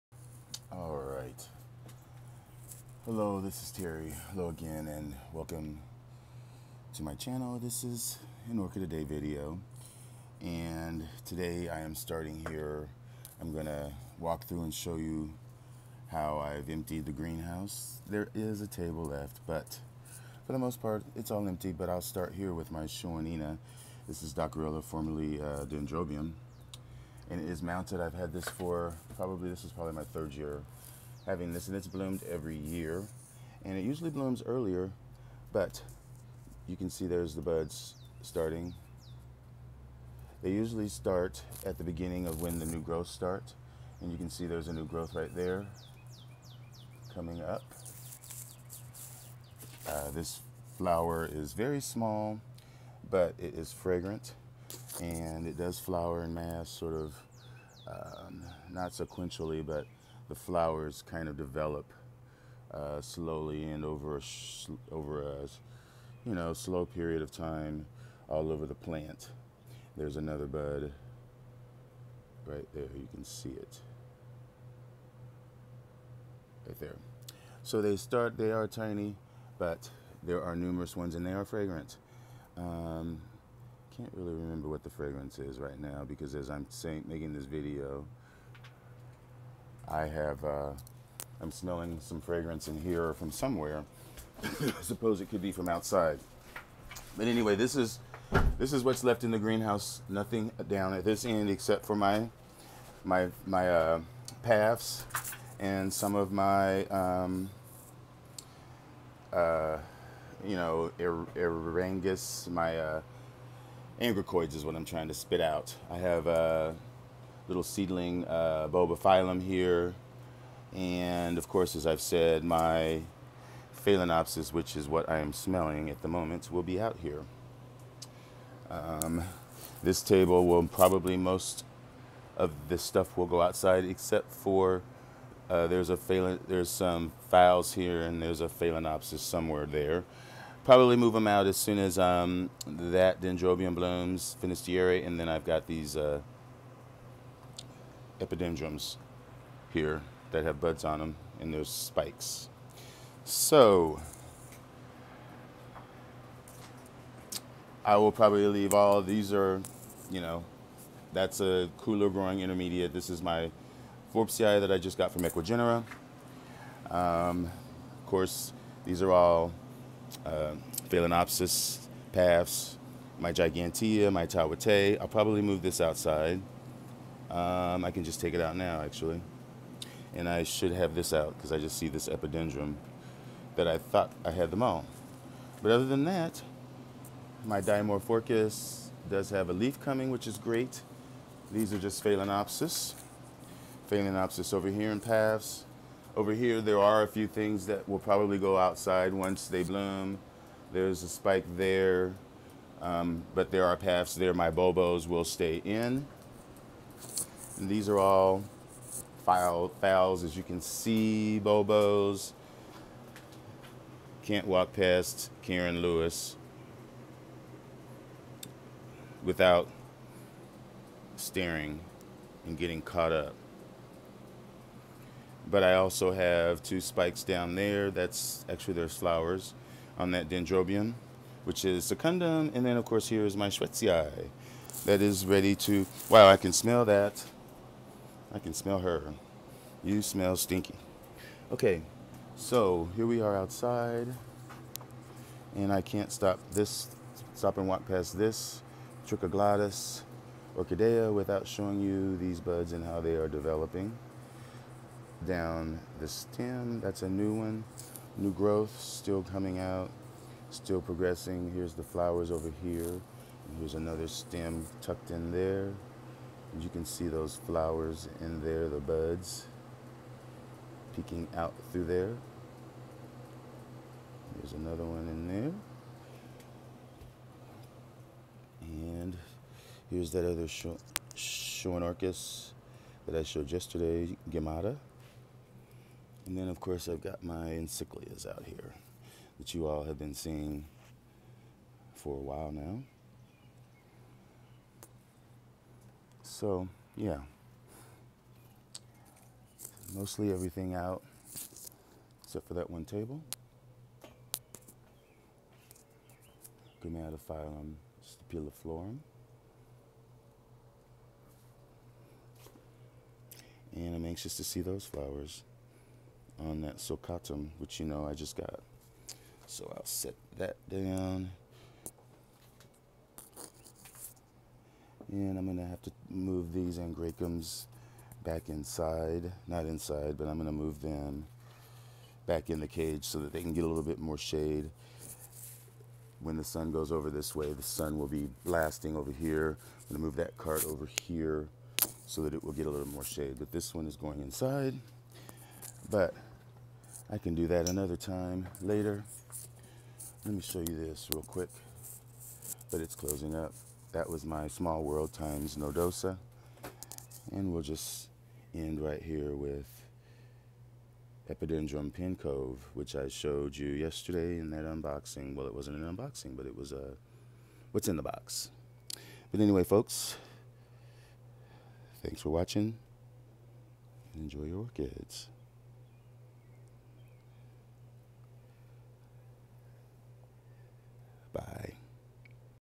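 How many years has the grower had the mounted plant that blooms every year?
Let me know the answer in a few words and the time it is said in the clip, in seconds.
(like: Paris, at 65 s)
3, at 30 s.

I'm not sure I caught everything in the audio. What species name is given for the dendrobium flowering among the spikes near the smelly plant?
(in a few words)
secundum.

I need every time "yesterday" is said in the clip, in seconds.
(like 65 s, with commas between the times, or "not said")
283 s, 363 s.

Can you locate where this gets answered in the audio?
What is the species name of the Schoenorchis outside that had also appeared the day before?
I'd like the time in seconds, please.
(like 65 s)
284 s.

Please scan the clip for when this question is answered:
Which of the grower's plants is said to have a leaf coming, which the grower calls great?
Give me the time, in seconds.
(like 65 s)
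187 s.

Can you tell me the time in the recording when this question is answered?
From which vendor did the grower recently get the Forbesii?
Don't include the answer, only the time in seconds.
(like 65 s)
165 s.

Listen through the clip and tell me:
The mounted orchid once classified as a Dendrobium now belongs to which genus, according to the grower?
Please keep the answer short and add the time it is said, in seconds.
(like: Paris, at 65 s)
Dockrillia, at 24 s.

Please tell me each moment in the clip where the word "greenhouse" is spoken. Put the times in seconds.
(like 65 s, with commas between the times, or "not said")
17 s, 99 s.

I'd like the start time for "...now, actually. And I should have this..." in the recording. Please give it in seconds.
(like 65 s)
178 s.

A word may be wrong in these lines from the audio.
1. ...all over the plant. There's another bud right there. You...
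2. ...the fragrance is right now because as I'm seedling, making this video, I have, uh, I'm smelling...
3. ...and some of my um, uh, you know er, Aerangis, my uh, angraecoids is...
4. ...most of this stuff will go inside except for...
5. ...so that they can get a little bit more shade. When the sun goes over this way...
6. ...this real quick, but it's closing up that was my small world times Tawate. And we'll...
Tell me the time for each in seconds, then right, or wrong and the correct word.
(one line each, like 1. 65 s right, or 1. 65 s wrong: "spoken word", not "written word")
1. 68 s right
2. 84 s wrong: "saying", not "seedling"
3. 105 s right
4. 131 s wrong: "outside", not "inside"
5. 333 s right
6. 350 s wrong: "Nodosa", not "Tawate".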